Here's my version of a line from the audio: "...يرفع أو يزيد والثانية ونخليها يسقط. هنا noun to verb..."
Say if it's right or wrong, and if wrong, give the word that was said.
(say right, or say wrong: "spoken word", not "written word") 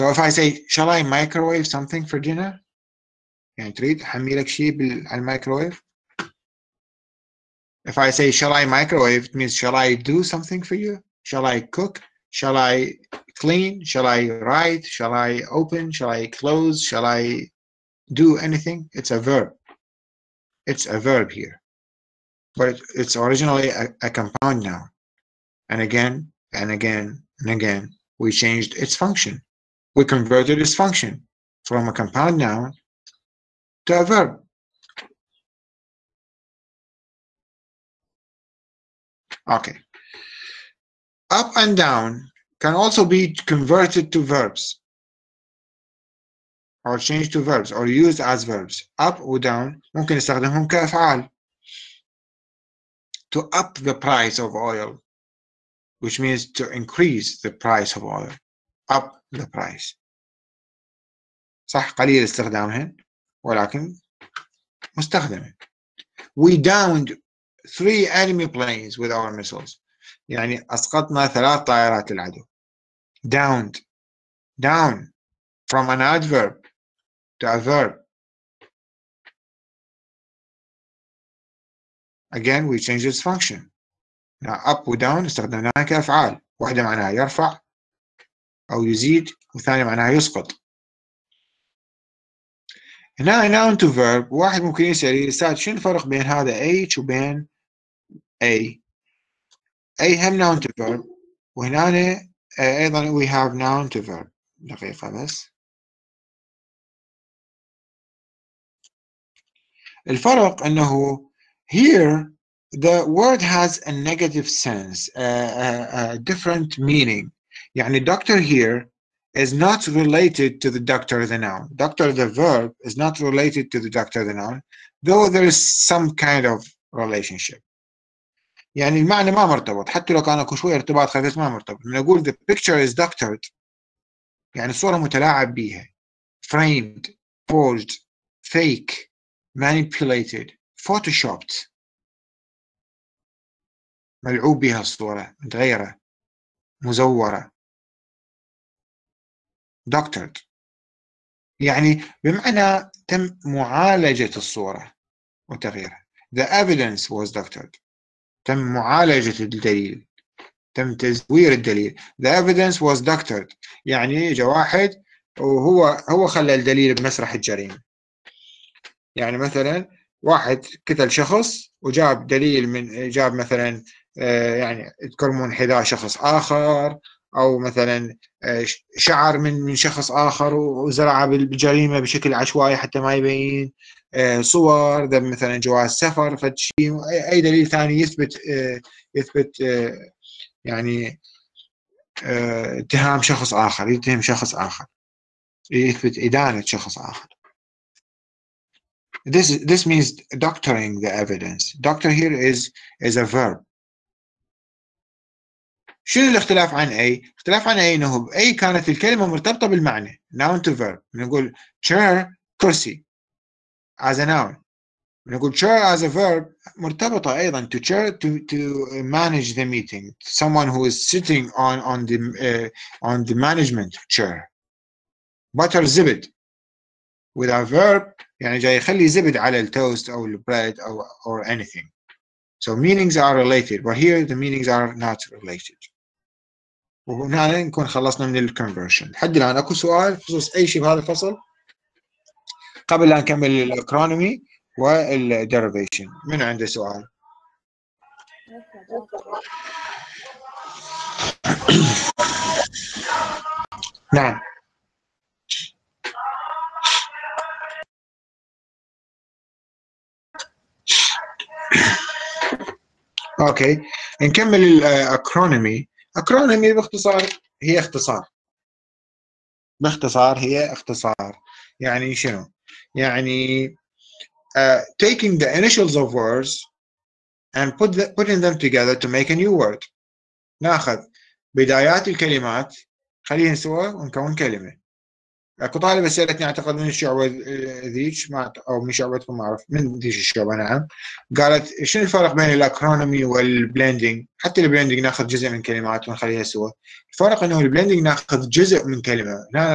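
wrong: "معناها", not "ونخليها".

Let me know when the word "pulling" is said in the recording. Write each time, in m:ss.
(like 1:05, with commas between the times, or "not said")
not said.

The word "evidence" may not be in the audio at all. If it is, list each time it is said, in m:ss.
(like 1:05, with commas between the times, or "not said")
2:36, 2:42, 3:21.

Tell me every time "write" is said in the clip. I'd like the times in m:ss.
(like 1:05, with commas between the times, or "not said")
0:14.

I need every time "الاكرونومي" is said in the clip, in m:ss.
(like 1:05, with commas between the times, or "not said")
4:03, 4:24, 4:52.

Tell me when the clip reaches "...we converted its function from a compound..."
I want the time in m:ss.
0:29.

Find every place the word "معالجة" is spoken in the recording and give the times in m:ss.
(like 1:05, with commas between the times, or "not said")
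2:33, 2:38.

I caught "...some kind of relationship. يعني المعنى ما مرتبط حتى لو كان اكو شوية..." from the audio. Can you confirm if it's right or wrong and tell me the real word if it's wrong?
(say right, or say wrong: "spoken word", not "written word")
right.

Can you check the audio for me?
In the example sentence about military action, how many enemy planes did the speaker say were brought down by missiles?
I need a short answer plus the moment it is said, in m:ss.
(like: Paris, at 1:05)
3, at 1:07.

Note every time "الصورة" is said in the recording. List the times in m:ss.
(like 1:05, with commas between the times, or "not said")
2:14, 2:24, 2:34.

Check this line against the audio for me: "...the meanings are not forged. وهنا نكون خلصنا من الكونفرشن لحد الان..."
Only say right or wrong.
wrong.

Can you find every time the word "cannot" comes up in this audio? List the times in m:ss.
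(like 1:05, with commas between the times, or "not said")
not said.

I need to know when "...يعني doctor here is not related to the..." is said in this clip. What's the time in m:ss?
1:57.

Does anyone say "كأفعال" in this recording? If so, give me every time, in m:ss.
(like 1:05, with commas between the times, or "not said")
0:50, 1:25.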